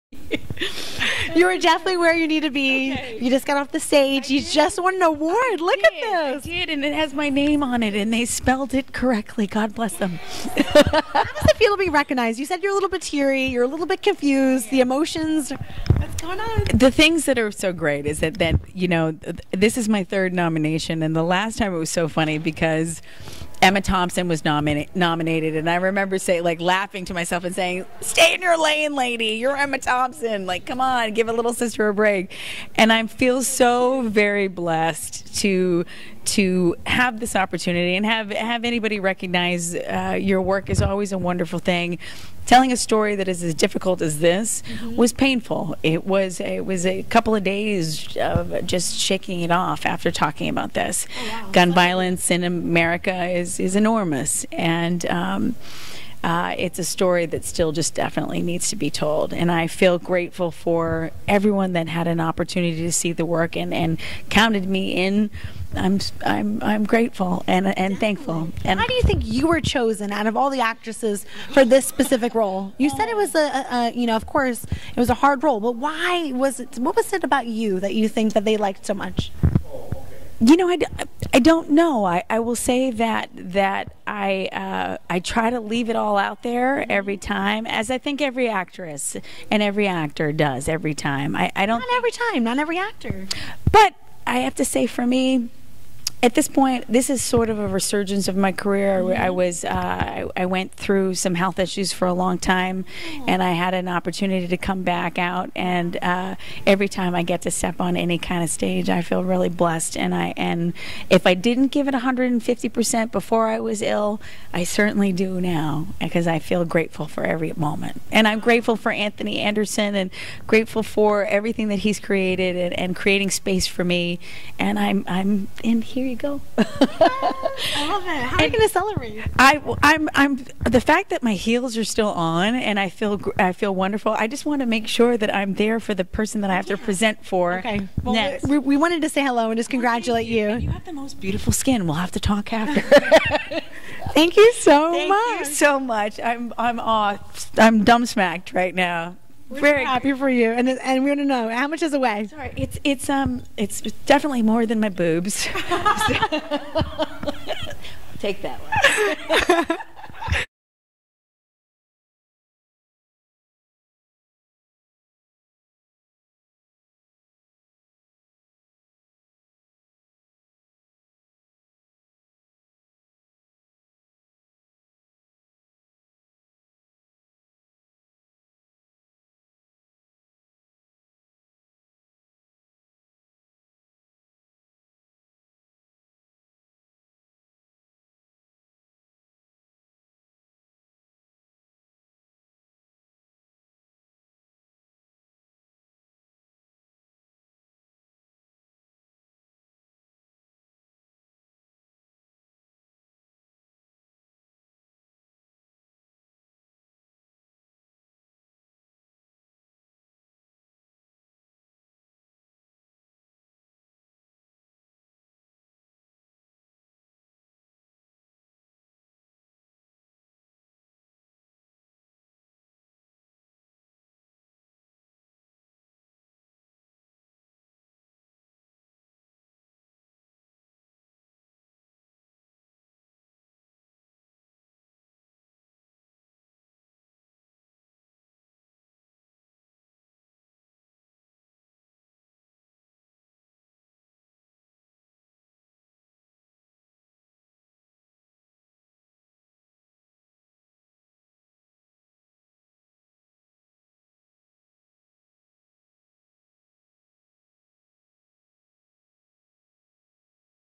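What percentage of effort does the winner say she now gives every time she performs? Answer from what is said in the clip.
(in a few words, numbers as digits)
150 percent.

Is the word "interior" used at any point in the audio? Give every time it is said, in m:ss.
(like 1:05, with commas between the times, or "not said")
not said.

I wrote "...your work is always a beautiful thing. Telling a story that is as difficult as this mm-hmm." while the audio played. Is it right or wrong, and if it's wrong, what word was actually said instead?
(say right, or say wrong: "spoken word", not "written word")
wrong: "wonderful", not "beautiful".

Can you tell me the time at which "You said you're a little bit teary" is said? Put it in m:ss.
0:12.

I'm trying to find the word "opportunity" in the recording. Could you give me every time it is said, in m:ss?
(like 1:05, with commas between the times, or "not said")
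0:37, 1:02, 1:43.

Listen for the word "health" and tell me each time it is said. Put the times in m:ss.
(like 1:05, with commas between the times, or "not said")
1:41.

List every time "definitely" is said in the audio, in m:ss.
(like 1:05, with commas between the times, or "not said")
0:01, 0:57, 2:34.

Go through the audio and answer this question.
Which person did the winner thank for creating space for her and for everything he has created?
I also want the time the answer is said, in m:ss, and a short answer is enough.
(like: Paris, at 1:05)
Anthony Anderson, at 1:58.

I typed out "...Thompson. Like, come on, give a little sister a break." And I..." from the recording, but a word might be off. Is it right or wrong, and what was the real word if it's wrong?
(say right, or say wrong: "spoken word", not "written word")
right.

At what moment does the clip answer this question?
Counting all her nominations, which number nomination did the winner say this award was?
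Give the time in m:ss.
0:20.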